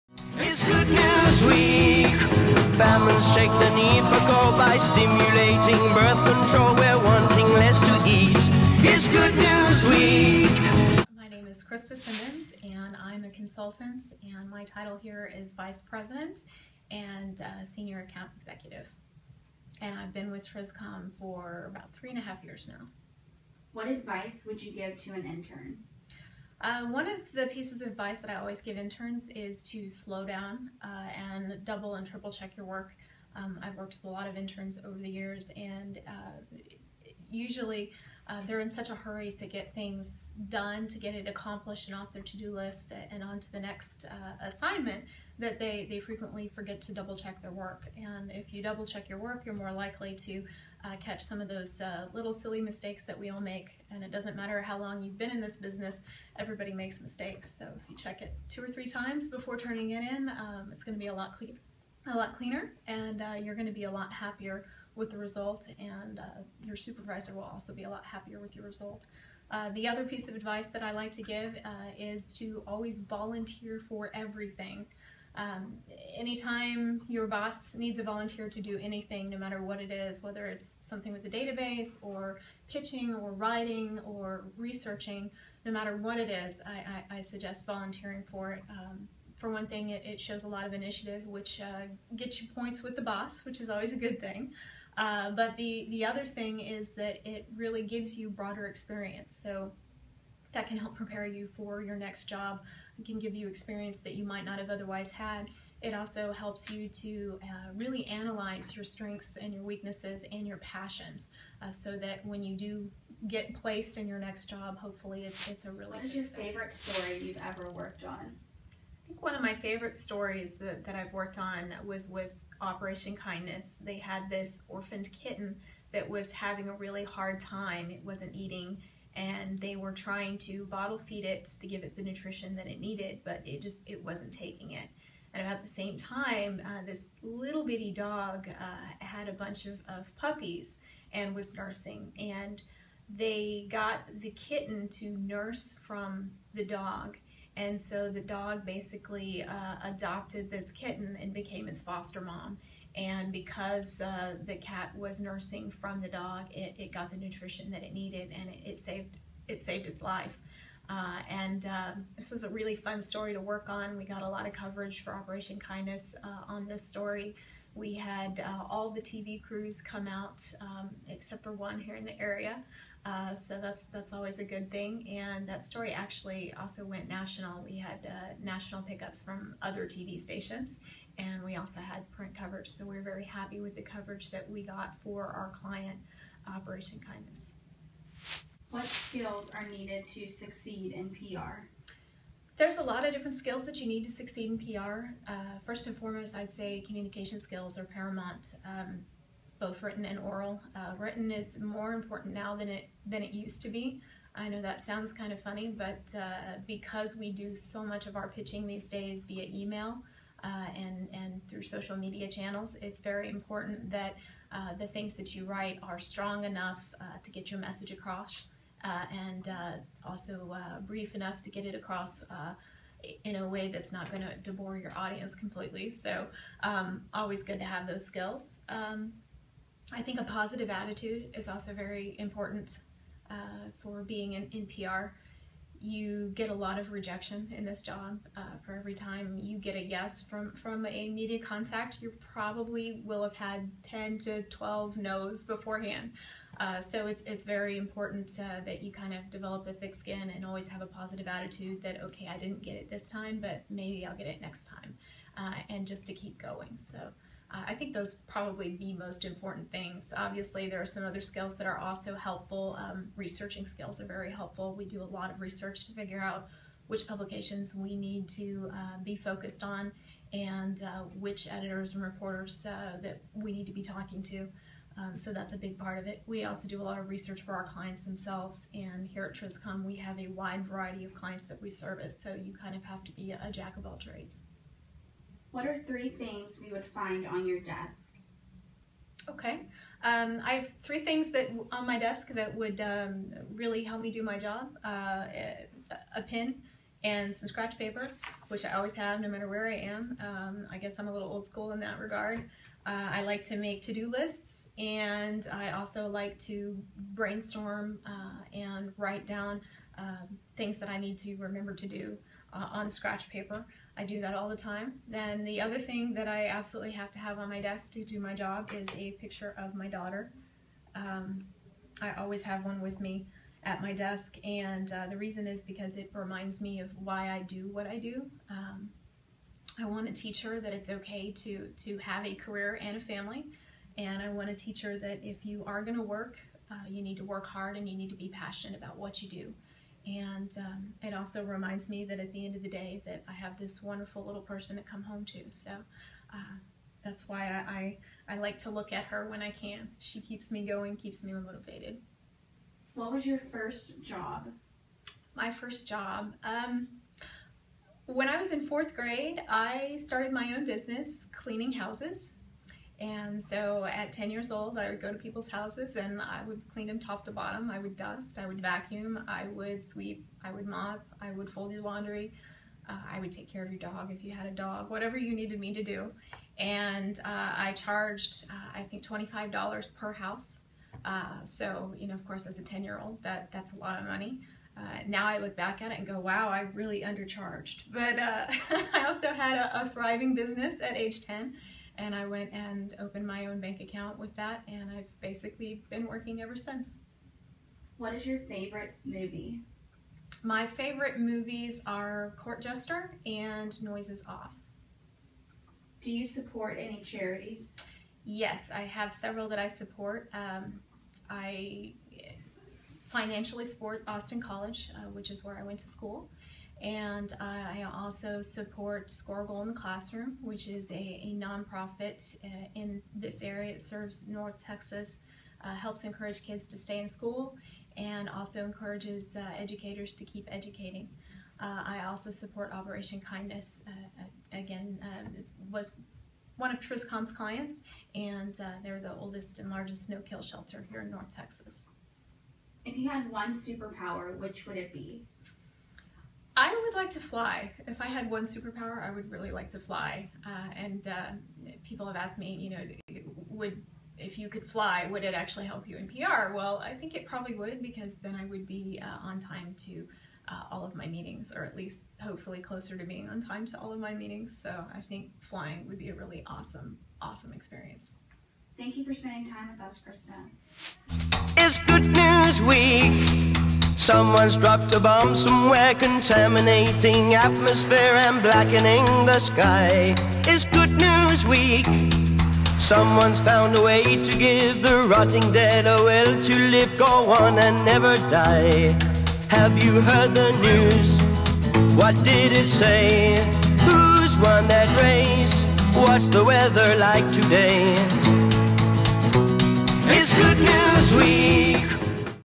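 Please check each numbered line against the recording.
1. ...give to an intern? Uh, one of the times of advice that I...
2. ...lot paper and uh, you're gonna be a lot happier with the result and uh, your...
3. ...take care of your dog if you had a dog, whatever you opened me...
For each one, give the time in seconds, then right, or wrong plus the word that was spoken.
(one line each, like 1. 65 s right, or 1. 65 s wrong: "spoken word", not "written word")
1. 24 s wrong: "pieces", not "times"
2. 62 s wrong: "cleaner", not "paper"
3. 373 s wrong: "needed", not "opened".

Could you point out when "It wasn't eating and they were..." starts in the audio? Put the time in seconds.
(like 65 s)
127 s.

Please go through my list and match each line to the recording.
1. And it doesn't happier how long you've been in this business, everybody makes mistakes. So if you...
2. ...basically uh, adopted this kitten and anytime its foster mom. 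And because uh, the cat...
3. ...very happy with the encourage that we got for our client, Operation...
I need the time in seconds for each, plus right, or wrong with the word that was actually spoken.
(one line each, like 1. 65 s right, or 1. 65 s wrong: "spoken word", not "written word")
1. 53 s wrong: "matter", not "happier"
2. 148 s wrong: "became", not "anytime"
3. 183 s wrong: "coverage", not "encourage".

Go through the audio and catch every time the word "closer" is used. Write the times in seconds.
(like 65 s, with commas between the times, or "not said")
462 s.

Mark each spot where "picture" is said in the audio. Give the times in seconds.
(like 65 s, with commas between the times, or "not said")
319 s.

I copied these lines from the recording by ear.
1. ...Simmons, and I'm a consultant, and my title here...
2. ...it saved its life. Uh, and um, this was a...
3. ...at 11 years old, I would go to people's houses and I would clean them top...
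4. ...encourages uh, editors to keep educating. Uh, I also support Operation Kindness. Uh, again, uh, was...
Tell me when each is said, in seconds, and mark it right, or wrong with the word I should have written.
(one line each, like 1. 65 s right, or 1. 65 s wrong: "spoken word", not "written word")
1. 11 s right
2. 159 s right
3. 363 s wrong: "10", not "11"
4. 428 s wrong: "educators", not "editors".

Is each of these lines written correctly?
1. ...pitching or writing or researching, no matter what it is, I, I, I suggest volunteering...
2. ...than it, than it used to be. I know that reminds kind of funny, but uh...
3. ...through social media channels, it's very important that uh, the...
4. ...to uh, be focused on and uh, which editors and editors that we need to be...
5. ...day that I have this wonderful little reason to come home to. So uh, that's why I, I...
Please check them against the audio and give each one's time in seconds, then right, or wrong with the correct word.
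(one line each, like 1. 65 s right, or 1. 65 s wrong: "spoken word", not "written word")
1. 82 s right
2. 202 s wrong: "sounds", not "reminds"
3. 211 s right
4. 268 s wrong: "reporters", not "editors"
5. 342 s wrong: "person", not "reason".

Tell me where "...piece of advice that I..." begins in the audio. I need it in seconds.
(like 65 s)
70 s.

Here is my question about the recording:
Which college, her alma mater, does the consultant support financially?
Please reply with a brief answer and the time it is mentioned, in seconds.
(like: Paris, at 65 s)
Austin College, at 414 s.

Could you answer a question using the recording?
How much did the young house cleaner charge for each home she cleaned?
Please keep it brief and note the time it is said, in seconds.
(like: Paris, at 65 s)
$25, at 379 s.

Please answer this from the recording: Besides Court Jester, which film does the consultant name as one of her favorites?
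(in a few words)
Noises Off.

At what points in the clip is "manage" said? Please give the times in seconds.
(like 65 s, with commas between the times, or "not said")
not said.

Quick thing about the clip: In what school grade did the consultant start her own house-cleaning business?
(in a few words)
fourth grade.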